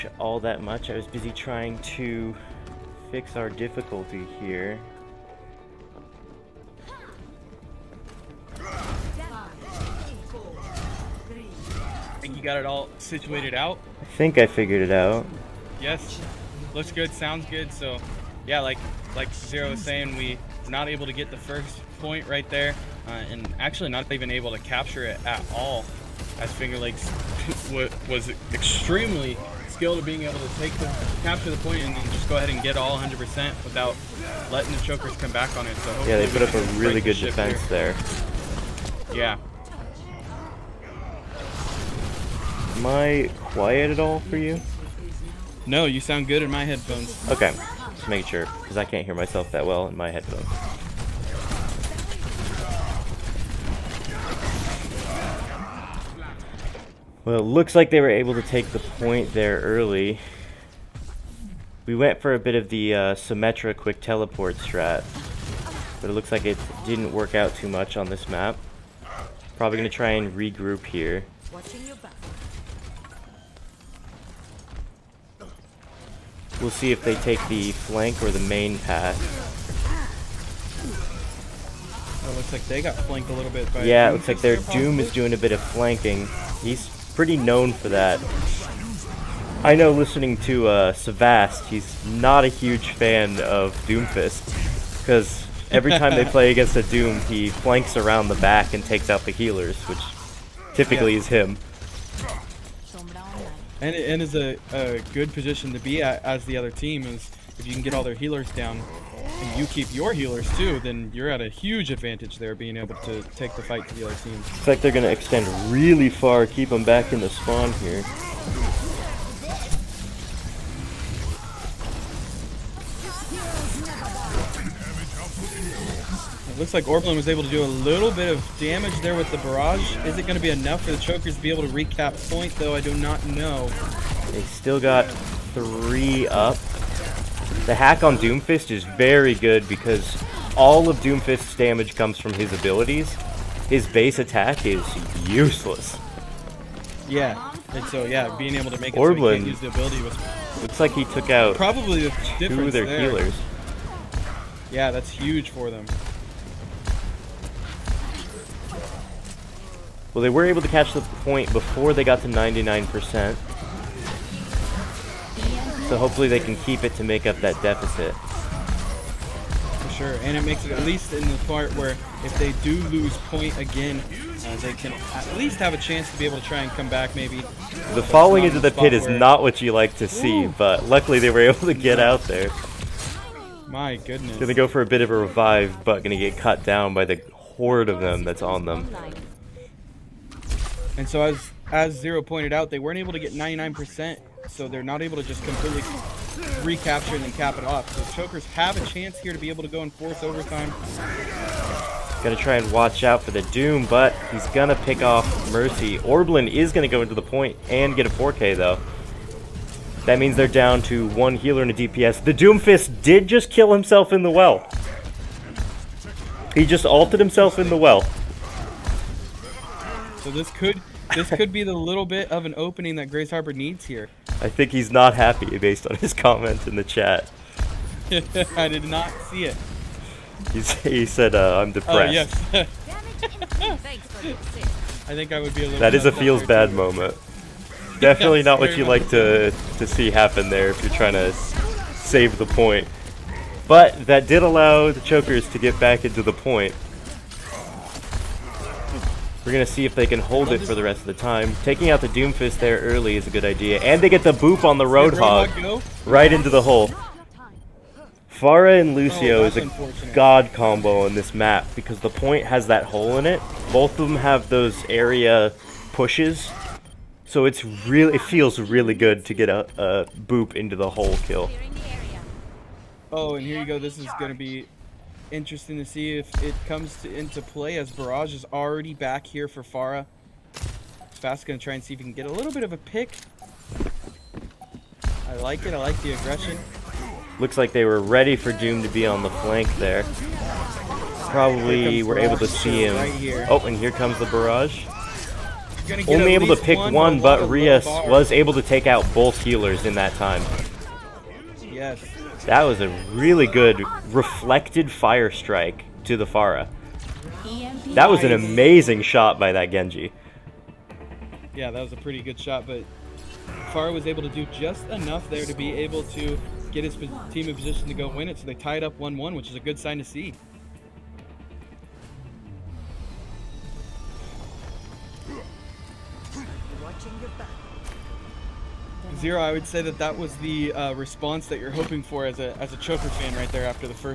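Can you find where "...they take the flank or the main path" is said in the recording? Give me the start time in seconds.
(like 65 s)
77 s.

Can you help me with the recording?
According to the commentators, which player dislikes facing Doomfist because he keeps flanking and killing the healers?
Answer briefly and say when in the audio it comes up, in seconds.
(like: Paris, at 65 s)
Savast, at 90 s.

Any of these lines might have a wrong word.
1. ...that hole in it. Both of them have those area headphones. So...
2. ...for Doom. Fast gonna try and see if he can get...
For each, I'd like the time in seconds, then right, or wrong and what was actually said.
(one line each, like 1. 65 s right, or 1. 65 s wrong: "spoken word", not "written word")
1. 262 s wrong: "pushes", not "headphones"
2. 279 s wrong: "Pharah", not "Doom".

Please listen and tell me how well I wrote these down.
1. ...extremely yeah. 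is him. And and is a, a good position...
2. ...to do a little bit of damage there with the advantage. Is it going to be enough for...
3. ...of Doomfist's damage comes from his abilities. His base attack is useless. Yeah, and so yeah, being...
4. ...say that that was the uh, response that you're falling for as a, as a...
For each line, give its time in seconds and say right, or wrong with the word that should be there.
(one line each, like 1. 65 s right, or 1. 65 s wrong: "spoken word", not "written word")
1. 100 s wrong: "typically", not "extremely"
2. 127 s wrong: "barrage", not "advantage"
3. 140 s right
4. 329 s wrong: "hoping", not "falling".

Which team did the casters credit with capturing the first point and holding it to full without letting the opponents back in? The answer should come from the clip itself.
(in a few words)
Finger Lakes.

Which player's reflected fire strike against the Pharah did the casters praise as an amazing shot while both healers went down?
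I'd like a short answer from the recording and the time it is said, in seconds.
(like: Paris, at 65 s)
Rias, at 297 s.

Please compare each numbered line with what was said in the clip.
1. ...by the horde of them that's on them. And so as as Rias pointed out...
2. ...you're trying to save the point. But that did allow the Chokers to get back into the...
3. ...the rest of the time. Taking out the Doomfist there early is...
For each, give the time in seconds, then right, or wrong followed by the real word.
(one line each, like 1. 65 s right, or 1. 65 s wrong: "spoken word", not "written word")
1. 186 s wrong: "Zero", not "Rias"
2. 240 s right
3. 250 s right.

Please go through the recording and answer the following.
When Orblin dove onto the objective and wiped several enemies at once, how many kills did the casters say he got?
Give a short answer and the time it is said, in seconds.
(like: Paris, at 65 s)
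4, at 208 s.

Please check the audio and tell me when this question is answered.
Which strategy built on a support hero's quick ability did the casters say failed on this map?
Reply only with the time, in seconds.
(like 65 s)
63 s.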